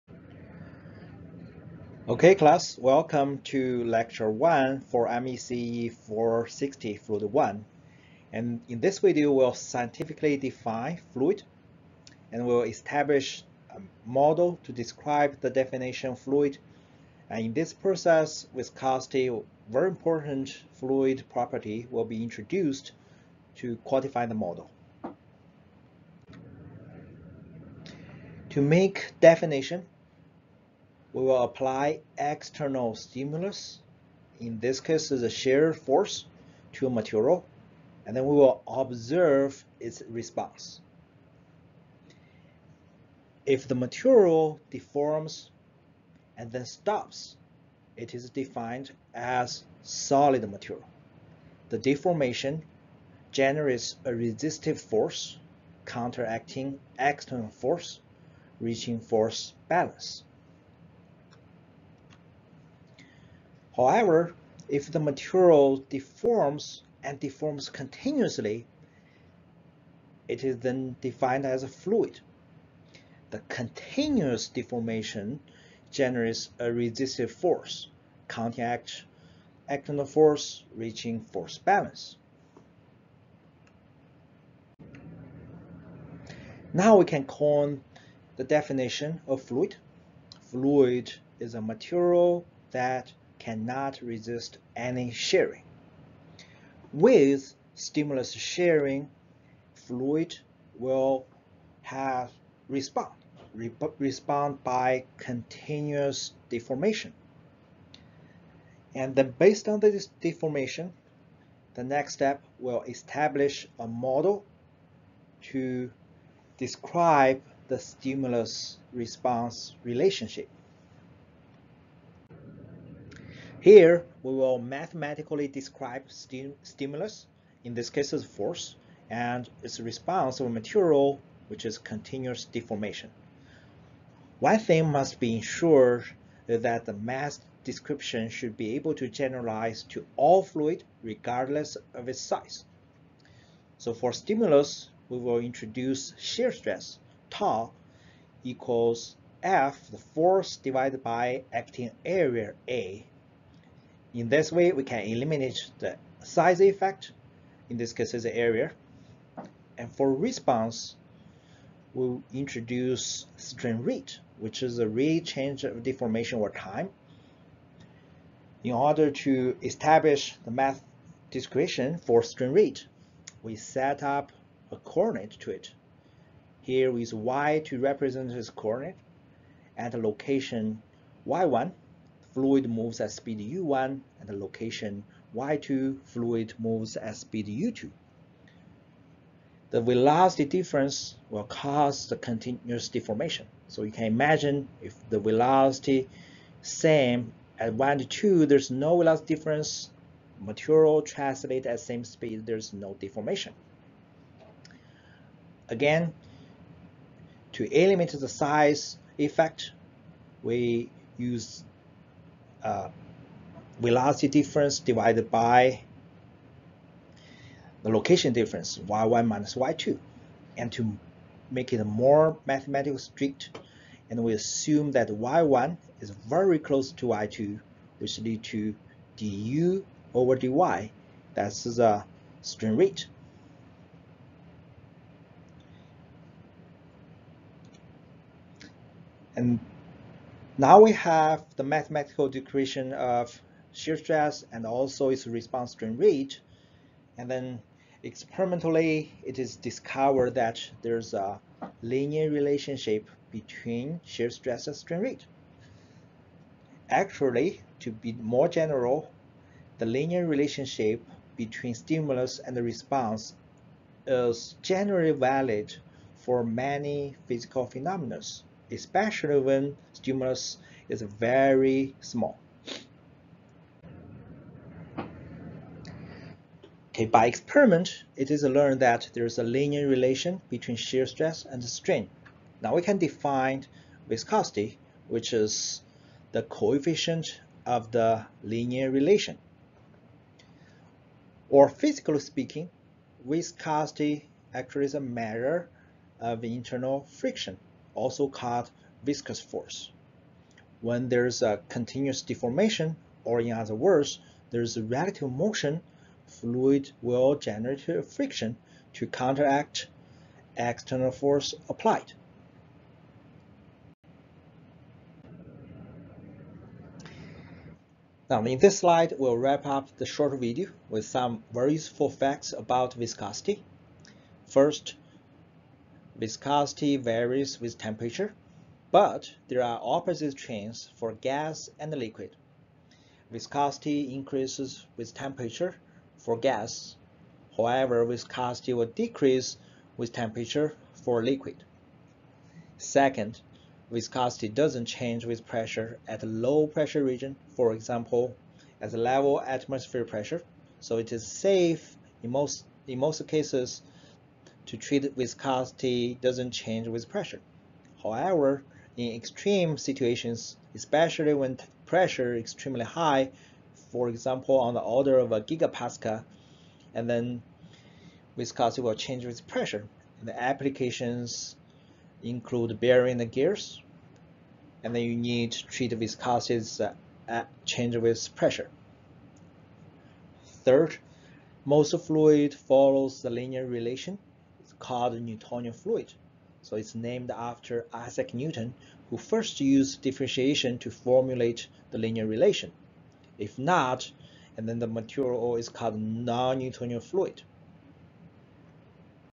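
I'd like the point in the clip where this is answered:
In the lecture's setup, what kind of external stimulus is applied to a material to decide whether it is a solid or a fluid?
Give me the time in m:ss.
0:35.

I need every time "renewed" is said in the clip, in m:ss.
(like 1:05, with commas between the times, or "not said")
not said.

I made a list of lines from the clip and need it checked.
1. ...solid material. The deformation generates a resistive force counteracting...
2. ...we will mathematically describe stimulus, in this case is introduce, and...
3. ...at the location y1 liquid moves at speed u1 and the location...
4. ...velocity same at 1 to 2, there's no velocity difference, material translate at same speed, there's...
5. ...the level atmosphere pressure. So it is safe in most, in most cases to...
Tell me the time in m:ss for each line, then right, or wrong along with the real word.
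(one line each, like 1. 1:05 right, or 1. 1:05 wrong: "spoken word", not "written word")
1. 0:49 right
2. 2:04 wrong: "force", not "introduce"
3. 2:59 wrong: "fluid", not "liquid"
4. 3:15 right
5. 5:48 right.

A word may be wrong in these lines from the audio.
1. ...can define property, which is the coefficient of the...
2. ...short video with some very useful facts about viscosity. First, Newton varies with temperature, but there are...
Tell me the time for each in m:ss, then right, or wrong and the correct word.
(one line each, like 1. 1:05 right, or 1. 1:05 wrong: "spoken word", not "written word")
1. 4:42 wrong: "viscosity", not "property"
2. 5:20 wrong: "Viscosity", not "Newton".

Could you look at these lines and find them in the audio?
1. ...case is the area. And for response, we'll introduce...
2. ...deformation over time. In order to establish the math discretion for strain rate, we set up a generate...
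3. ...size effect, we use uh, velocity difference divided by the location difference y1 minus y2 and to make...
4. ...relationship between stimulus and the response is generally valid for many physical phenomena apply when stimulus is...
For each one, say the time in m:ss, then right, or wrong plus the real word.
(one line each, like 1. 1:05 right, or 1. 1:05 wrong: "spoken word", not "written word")
1. 2:37 right
2. 2:45 wrong: "coordinate", not "generate"
3. 3:28 right
4. 4:20 wrong: "especially", not "apply".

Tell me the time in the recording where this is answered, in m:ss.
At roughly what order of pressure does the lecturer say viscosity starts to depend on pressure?
6:05.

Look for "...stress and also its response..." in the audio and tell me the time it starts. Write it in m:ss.
4:03.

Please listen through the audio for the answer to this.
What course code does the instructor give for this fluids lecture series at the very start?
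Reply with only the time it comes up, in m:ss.
0:05.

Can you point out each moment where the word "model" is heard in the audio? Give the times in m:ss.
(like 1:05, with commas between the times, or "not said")
0:14, 0:24, 1:53.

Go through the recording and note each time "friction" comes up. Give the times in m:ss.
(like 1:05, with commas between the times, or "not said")
4:57, 5:08.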